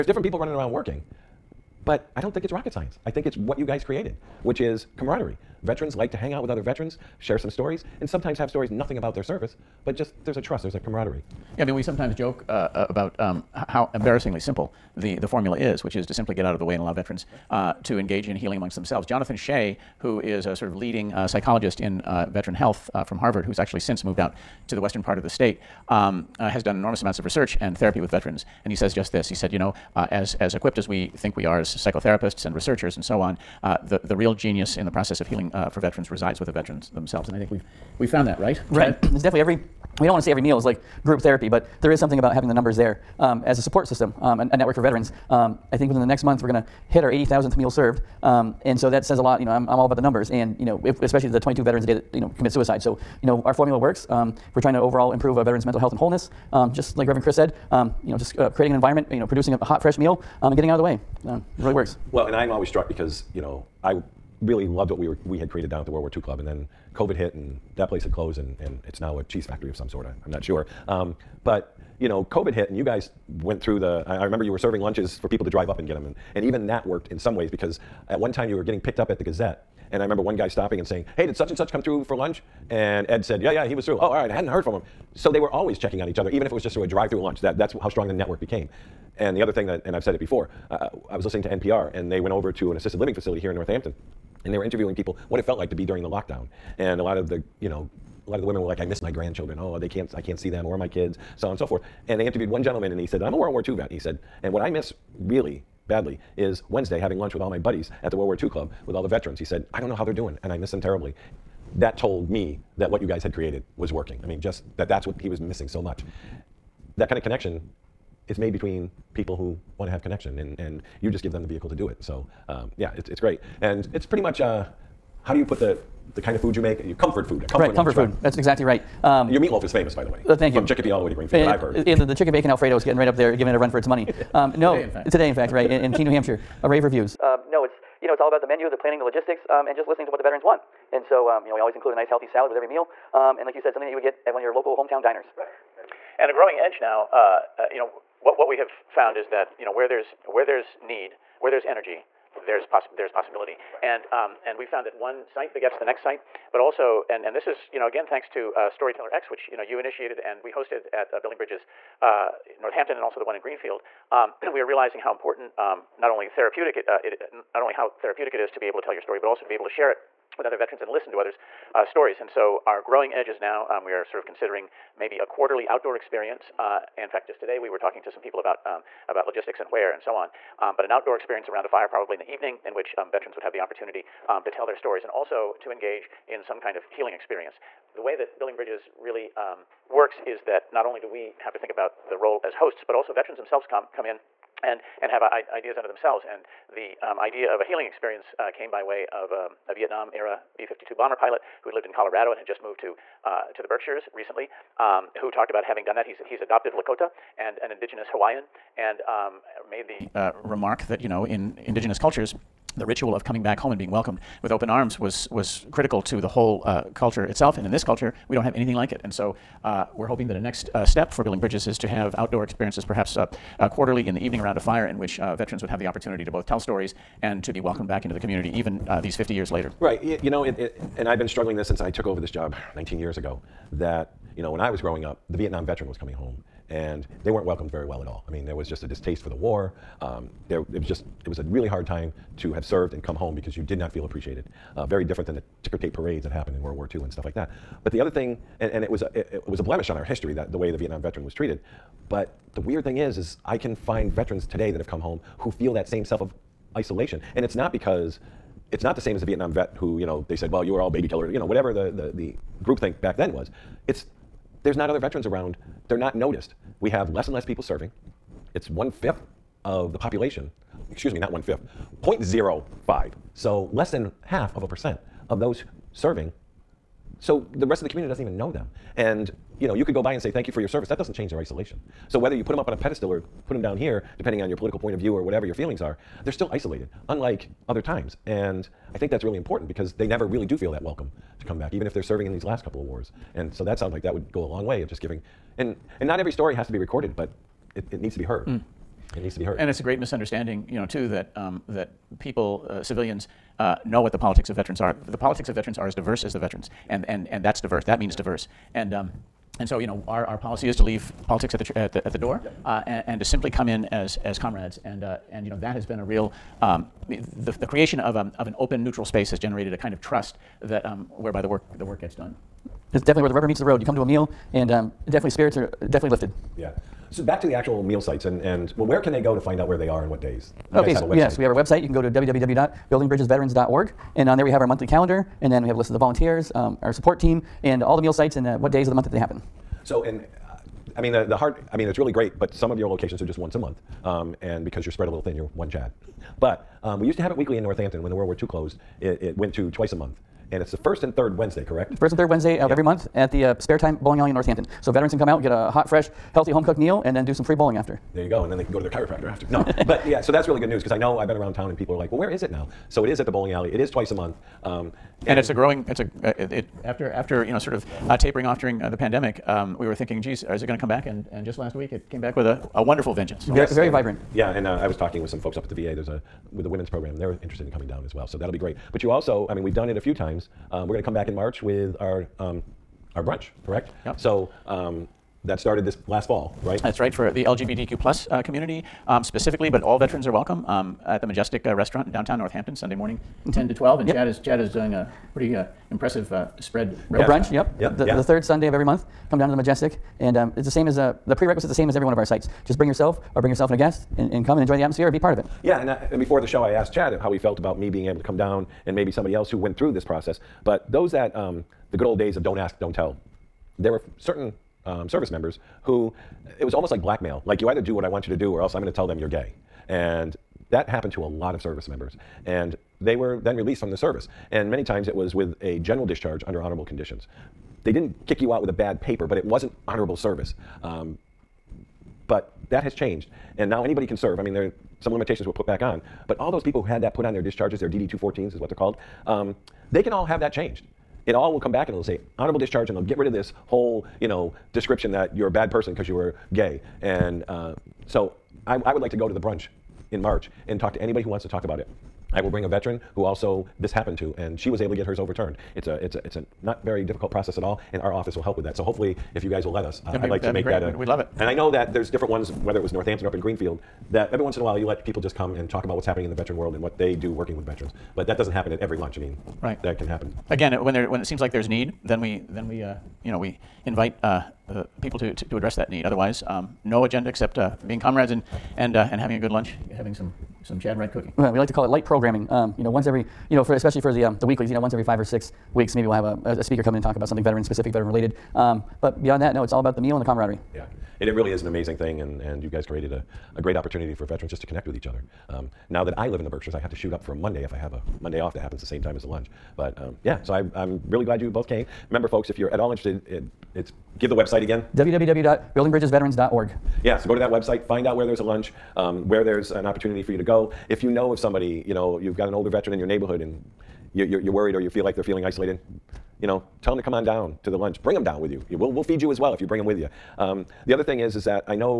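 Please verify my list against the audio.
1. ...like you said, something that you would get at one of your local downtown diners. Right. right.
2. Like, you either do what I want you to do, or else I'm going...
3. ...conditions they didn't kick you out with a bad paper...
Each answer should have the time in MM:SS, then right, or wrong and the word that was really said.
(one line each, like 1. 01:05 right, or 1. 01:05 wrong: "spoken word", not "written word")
1. 02:23 wrong: "hometown", not "downtown"
2. 06:57 right
3. 07:06 right.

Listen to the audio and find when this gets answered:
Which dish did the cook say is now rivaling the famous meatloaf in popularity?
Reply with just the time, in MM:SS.
02:12.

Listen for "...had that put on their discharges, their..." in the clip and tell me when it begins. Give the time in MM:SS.
07:16.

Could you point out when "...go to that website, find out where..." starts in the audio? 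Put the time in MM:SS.
08:27.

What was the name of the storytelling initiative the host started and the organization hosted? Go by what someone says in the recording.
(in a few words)
Storyteller X.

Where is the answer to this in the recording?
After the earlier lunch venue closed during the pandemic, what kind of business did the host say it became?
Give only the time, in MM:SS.
01:09.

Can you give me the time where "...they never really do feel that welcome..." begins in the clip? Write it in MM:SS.
04:49.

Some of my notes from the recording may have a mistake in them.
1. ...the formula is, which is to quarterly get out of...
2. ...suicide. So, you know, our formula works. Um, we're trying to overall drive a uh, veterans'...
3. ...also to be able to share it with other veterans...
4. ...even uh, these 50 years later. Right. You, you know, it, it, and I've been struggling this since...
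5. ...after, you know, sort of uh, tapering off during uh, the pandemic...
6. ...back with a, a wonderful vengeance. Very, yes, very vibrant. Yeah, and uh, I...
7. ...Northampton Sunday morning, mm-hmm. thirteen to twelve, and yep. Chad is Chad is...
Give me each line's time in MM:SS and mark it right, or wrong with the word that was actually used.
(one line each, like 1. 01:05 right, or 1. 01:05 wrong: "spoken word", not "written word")
1. 00:15 wrong: "simply", not "quarterly"
2. 00:52 wrong: "improve", not "drive"
3. 02:49 right
4. 03:48 right
5. 06:07 right
6. 06:12 right
7. 06:32 wrong: "ten", not "thirteen".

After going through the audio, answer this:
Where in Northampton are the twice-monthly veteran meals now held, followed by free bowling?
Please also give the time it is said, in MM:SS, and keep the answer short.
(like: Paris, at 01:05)
Spare Time Bowling Alley, at 05:53.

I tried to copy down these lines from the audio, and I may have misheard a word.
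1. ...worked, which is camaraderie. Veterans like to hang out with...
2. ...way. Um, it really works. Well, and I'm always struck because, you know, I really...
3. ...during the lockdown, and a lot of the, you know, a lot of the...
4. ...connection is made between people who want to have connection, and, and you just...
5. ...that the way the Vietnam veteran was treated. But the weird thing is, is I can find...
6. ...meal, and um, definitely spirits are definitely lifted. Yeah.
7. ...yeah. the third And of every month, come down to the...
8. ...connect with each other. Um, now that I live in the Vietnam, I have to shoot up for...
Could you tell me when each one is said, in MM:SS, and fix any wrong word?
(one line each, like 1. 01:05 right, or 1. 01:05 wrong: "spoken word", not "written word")
1. 00:03 wrong: "created", not "worked"
2. 01:00 right
3. 01:35 right
4. 01:57 right
5. 04:10 right
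6. 05:24 right
7. 06:38 wrong: "Sunday", not "And"
8. 08:14 wrong: "Berkshires", not "Vietnam".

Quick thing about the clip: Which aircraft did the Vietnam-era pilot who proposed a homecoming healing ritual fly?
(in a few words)
B-52 bomber.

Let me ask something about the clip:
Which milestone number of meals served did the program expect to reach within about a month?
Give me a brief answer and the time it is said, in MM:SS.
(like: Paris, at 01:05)
80,000th, at 00:47.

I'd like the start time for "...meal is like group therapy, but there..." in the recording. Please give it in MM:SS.
00:40.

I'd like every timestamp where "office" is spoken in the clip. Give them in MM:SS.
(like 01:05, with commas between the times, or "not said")
07:38.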